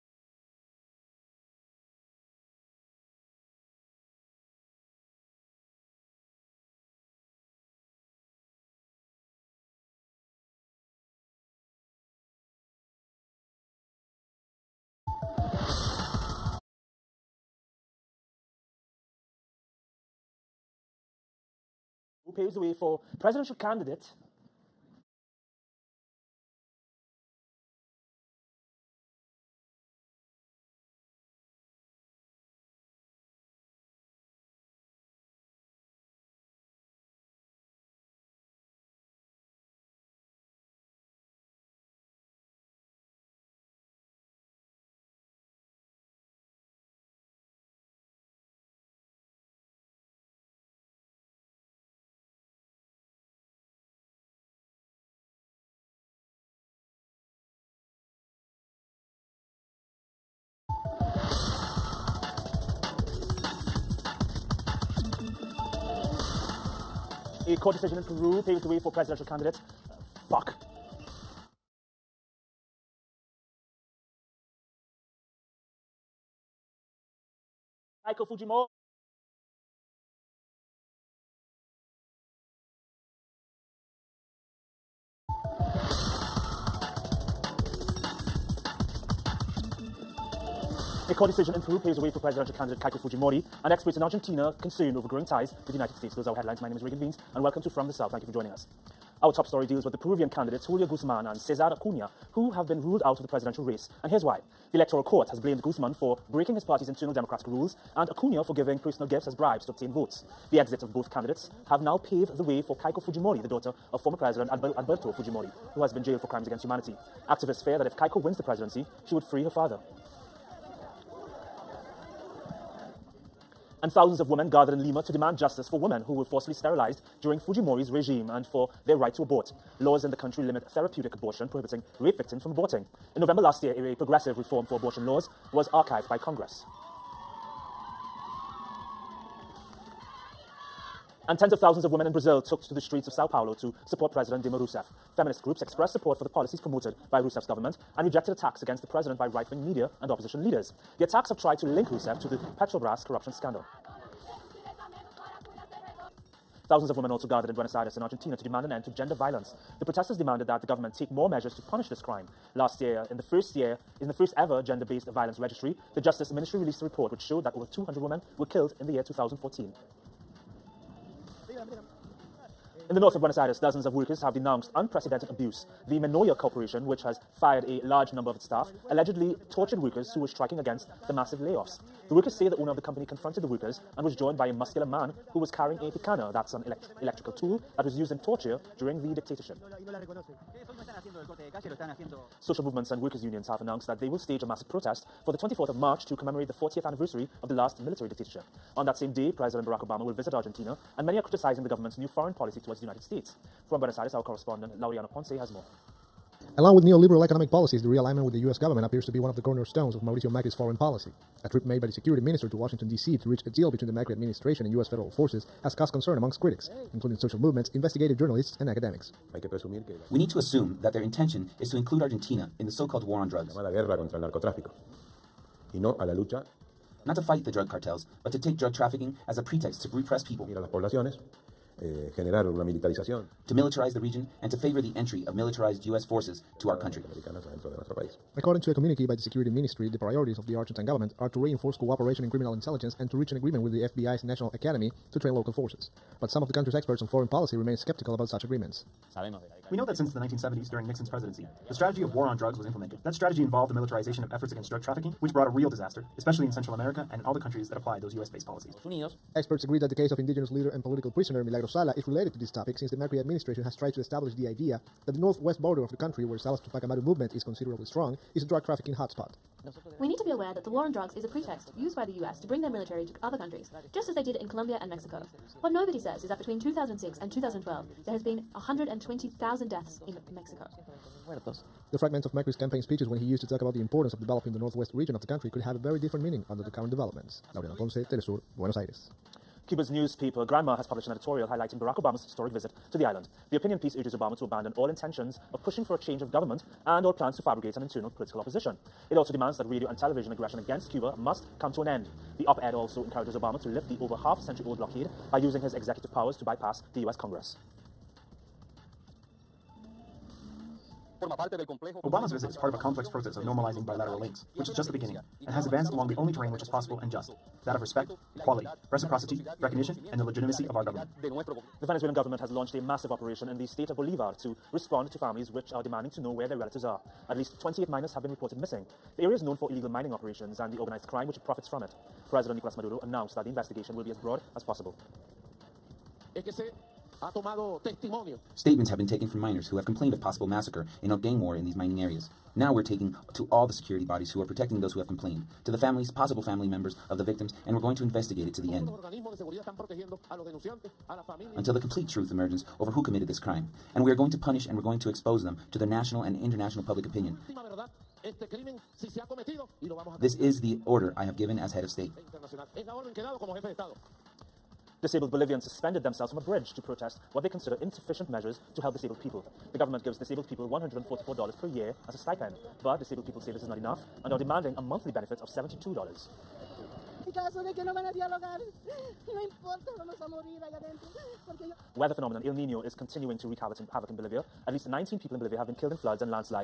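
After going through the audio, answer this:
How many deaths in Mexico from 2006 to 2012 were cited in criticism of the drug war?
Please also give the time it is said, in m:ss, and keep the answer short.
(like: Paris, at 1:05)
120,000, at 4:38.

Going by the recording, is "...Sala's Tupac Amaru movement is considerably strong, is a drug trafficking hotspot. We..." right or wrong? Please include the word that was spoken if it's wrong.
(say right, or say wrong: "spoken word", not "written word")
right.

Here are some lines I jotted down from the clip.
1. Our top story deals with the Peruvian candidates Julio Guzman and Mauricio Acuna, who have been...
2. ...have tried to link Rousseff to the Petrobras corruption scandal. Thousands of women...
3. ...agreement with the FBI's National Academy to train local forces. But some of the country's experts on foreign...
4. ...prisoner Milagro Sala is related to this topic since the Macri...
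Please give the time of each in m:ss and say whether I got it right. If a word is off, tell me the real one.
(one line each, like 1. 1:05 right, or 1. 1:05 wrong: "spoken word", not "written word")
1. 1:39 wrong: "Cesar", not "Mauricio"
2. 2:31 right
3. 4:03 right
4. 4:21 right.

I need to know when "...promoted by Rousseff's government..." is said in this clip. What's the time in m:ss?
2:26.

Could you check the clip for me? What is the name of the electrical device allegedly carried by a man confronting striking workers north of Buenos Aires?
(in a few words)
picana.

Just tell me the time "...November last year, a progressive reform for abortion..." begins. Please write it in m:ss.
2:13.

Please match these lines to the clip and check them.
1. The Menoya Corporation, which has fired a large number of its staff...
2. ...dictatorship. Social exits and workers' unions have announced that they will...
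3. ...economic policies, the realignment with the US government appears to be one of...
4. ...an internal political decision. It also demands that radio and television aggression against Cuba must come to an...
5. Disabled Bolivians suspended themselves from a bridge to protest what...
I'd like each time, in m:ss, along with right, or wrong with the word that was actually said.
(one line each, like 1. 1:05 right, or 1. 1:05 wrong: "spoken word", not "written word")
1. 2:55 right
2. 3:09 wrong: "movements", not "exits"
3. 3:27 right
4. 4:57 wrong: "opposition", not "decision"
5. 6:05 right.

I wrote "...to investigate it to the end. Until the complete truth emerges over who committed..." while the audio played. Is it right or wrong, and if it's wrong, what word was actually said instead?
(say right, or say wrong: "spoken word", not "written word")
right.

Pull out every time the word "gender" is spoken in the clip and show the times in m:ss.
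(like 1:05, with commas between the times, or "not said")
2:38, 2:44.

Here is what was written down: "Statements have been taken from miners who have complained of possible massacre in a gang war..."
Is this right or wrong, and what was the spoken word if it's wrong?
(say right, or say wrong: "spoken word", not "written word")
right.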